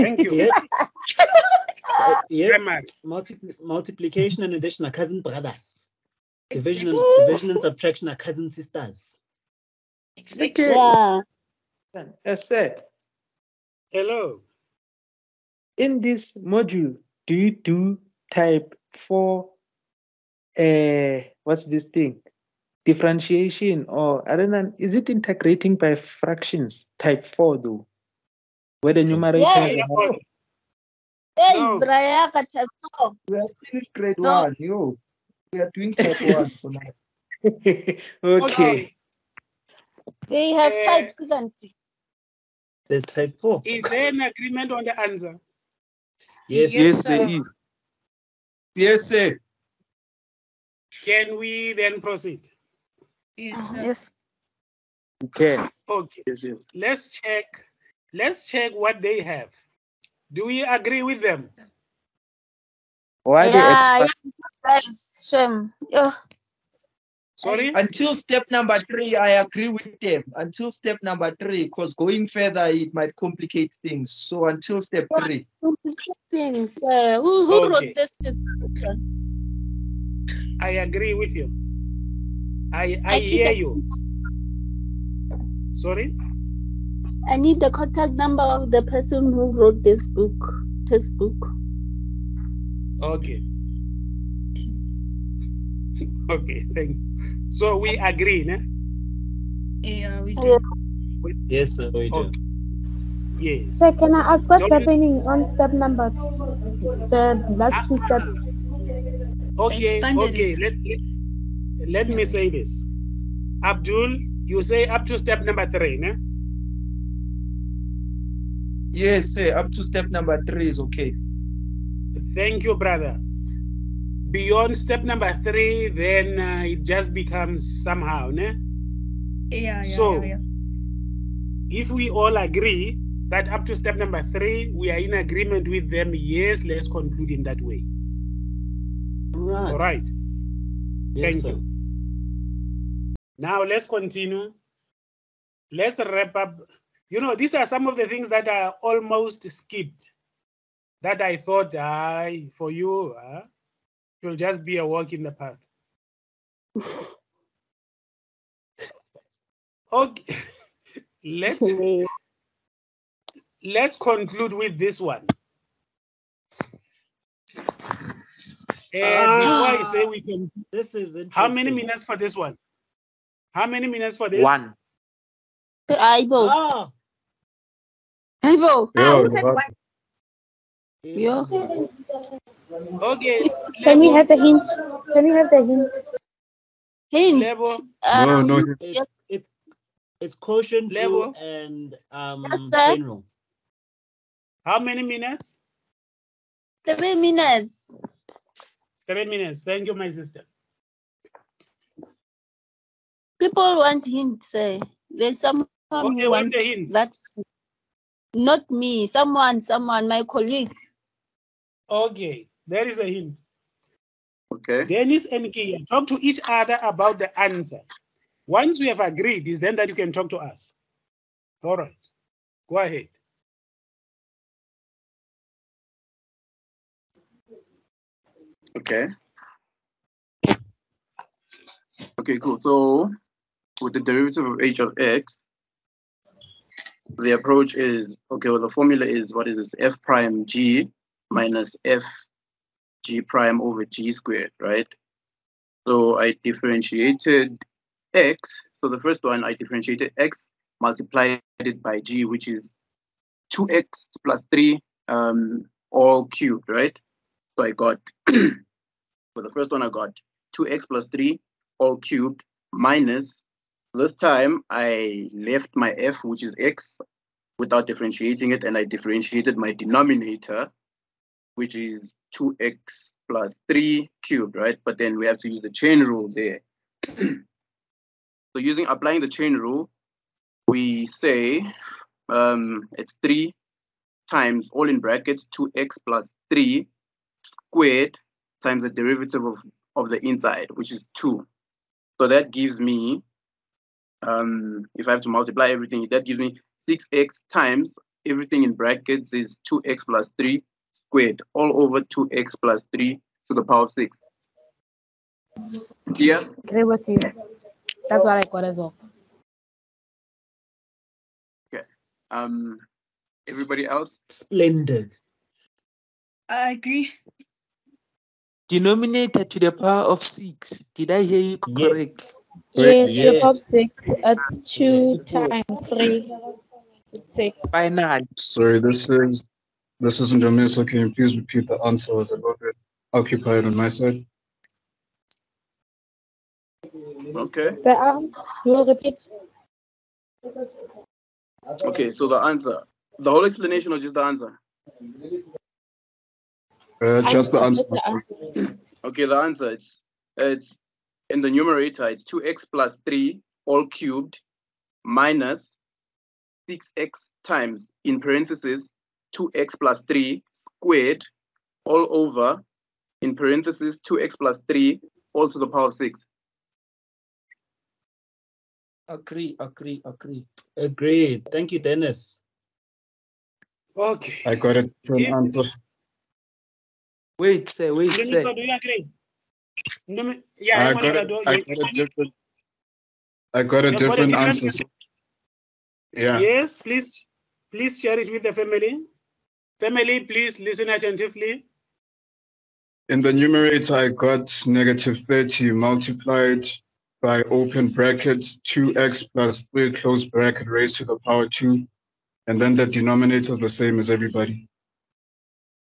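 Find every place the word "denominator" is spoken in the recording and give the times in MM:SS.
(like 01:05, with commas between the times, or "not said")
04:29, 05:18, 06:42.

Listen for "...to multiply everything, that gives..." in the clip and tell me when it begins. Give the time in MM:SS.
04:55.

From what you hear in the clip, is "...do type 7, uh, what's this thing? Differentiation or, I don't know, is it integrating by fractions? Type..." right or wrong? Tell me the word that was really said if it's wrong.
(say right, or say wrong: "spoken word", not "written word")
wrong: "4", not "7".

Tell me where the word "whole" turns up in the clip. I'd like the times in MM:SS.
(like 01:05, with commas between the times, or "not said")
05:43.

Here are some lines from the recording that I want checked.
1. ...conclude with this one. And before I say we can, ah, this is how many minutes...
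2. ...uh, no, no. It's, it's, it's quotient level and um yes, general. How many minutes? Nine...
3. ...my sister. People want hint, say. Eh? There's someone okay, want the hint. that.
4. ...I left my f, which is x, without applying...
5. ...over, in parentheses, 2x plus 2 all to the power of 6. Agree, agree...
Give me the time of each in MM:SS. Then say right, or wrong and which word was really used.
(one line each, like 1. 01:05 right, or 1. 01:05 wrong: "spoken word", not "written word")
1. 02:43 right
2. 03:08 wrong: "Three", not "Nine"
3. 03:19 right
4. 04:24 wrong: "differentiating", not "applying"
5. 06:02 wrong: "3", not "2".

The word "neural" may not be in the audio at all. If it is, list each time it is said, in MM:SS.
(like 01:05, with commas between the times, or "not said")
not said.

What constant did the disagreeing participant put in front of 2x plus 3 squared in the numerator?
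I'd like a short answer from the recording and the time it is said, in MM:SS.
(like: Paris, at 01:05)
-30, at 06:34.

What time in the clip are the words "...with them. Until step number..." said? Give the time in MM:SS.
01:09.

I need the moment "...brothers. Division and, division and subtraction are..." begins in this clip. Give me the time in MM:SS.
00:05.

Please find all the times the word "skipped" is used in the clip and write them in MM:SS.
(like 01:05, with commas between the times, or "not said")
02:29.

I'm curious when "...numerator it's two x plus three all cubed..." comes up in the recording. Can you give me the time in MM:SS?
05:51.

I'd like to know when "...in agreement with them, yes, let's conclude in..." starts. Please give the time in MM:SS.
02:14.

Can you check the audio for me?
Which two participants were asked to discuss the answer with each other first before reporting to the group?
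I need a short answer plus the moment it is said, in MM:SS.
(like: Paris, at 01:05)
Dennis and Kia, at 03:34.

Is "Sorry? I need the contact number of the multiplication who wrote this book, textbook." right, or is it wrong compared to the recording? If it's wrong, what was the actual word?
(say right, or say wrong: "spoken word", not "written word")
wrong: "person", not "multiplication".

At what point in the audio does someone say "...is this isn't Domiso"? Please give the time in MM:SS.
05:29.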